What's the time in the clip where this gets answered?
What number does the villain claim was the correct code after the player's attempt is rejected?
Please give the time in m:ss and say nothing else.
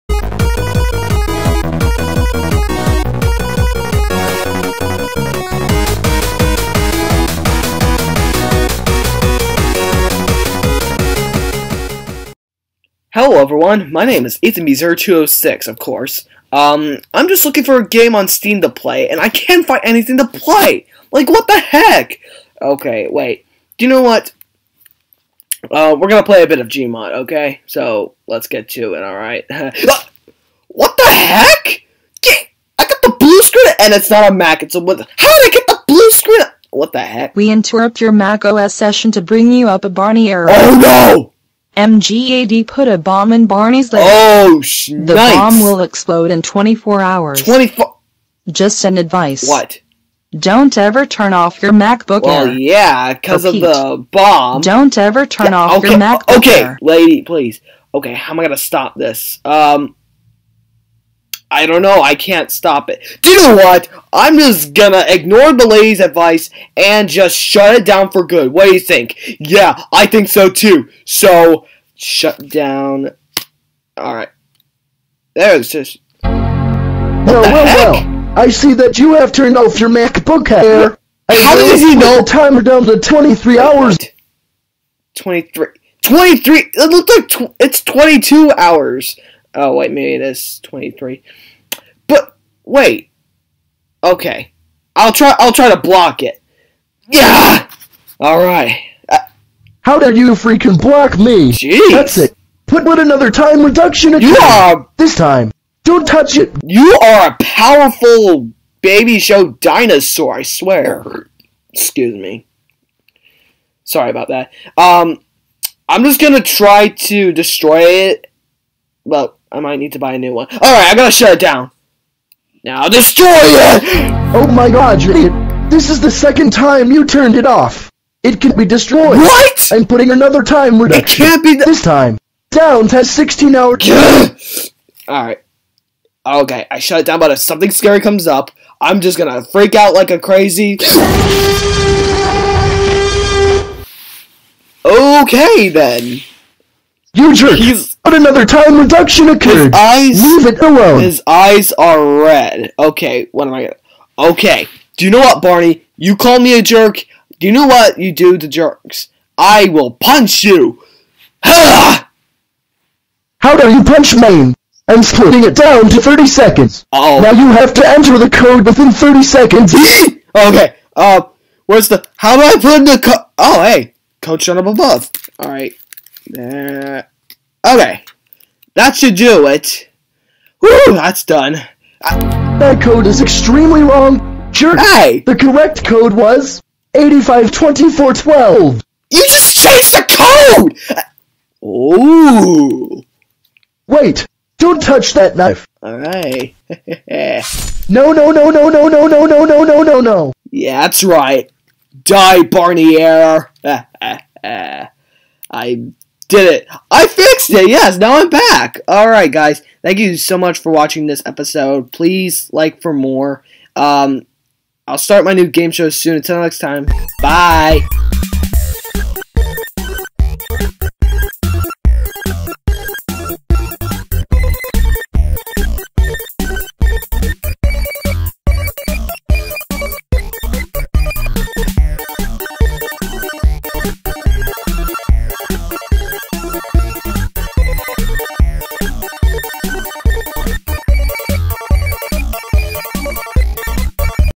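3:06.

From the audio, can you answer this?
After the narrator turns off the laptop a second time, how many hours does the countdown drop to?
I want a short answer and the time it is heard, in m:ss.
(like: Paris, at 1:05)
16, at 2:13.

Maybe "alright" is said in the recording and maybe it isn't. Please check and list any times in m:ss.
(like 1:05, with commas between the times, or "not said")
0:29, 1:13, 2:15, 3:15.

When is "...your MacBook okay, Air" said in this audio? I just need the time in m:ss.
0:55.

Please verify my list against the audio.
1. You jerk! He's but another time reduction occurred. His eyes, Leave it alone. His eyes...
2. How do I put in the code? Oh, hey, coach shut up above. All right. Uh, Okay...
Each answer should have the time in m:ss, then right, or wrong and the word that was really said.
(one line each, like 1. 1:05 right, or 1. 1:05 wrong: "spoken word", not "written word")
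1. 2:27 right
2. 2:52 right.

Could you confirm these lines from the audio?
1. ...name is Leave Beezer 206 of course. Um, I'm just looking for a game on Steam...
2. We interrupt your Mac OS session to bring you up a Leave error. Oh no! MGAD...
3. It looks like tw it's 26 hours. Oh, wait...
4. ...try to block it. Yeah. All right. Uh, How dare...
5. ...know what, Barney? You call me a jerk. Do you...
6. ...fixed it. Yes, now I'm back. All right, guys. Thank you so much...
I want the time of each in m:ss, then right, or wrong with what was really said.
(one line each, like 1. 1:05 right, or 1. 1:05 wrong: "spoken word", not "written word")
1. 0:14 wrong: "Ethan", not "Leave"
2. 0:37 wrong: "Barney", not "Leave"
3. 1:26 wrong: "22", not "26"
4. 1:35 right
5. 2:35 right
6. 3:27 right.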